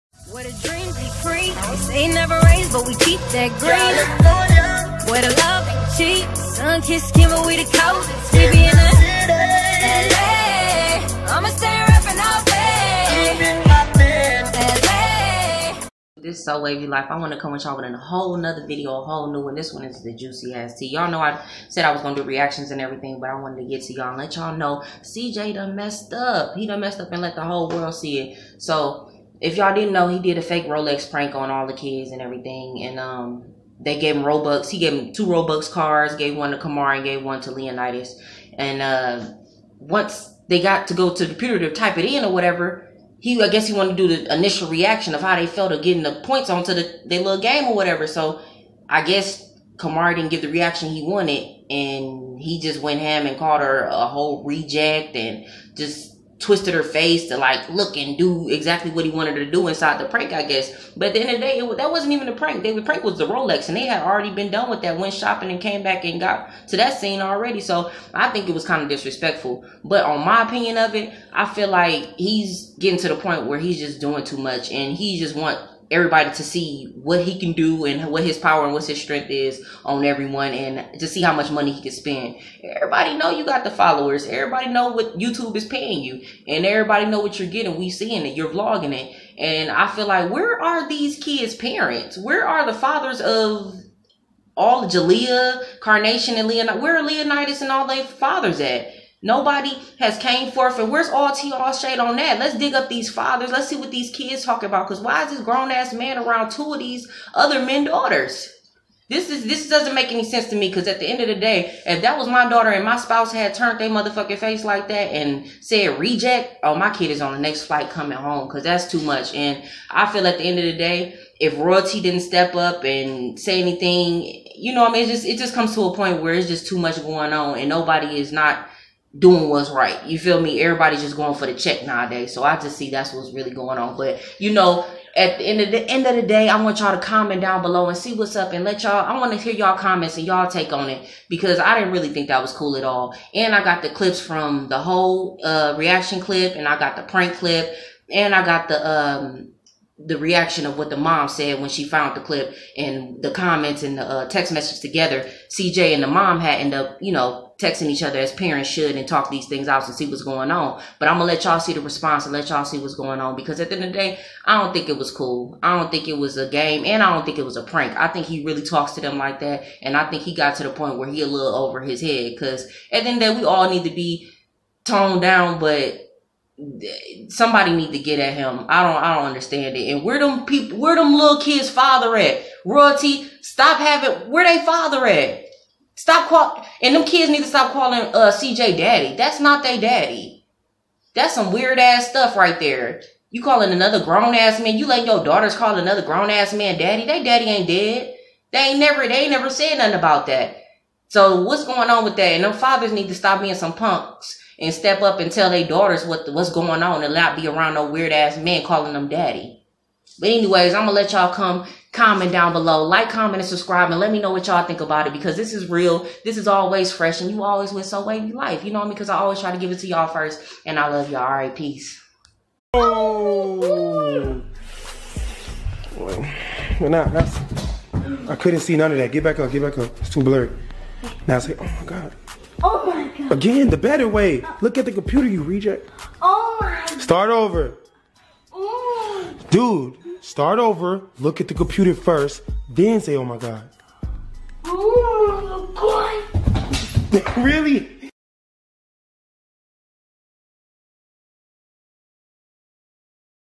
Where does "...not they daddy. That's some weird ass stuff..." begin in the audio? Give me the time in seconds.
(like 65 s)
189 s.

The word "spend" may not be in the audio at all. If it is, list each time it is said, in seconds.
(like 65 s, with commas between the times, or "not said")
81 s.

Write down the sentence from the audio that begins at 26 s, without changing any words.
He done messed up and let the whole world see it.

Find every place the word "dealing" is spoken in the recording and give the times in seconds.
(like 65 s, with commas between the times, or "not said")
not said.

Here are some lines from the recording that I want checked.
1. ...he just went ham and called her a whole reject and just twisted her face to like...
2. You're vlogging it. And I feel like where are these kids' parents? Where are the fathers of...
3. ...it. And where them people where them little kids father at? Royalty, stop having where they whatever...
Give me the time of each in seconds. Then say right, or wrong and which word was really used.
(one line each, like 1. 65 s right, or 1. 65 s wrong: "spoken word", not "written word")
1. 52 s right
2. 88 s right
3. 179 s wrong: "father", not "whatever".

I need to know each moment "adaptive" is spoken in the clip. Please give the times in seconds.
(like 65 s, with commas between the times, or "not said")
not said.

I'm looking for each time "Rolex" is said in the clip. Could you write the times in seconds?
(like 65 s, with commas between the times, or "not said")
30 s, 63 s.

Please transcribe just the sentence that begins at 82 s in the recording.
Everybody know you got the followers.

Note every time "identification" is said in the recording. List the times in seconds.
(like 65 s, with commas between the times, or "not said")
not said.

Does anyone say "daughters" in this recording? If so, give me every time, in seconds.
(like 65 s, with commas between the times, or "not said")
107 s, 112 s, 195 s, 205 s.